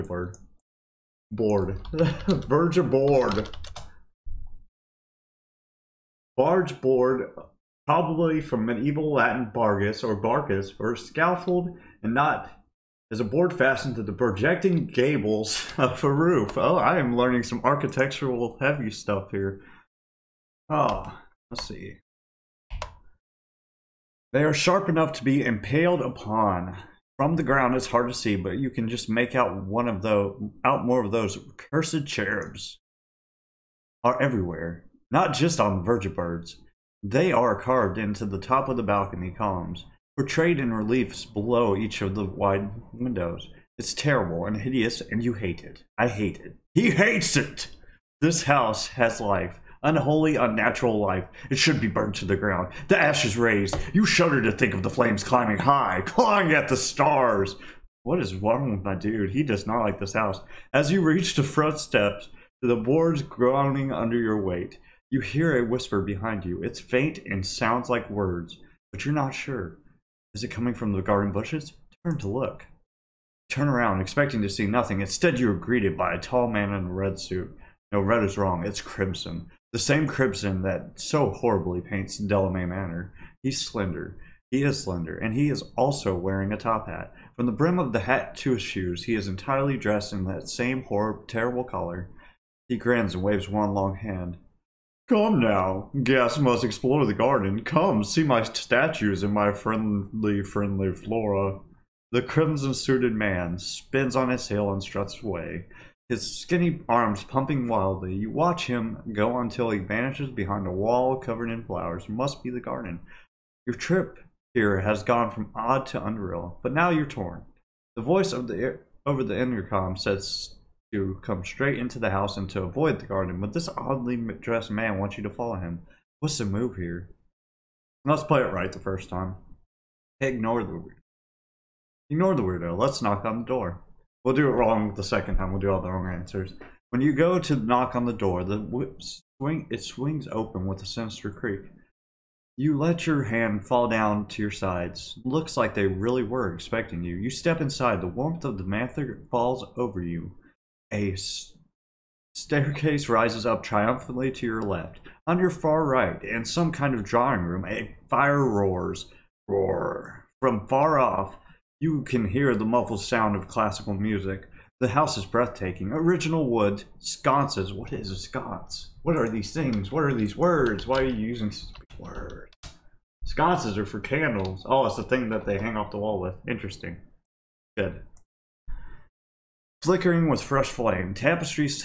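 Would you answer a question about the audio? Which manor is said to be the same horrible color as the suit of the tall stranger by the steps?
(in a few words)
Delamay Manor.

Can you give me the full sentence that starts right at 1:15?
Instead, you are greeted by a tall man in a red suit.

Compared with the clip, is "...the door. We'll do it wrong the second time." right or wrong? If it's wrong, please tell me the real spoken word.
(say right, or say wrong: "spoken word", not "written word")
right.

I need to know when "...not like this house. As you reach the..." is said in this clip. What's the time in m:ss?
0:59.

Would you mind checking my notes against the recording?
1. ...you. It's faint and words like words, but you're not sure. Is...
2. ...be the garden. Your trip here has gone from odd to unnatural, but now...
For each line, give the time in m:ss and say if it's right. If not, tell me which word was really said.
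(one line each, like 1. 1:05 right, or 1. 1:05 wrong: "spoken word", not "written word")
1. 1:06 wrong: "sounds", not "words"
2. 1:52 wrong: "unreal", not "unnatural".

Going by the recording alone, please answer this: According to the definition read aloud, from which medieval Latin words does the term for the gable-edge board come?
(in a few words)
bargus or barcus.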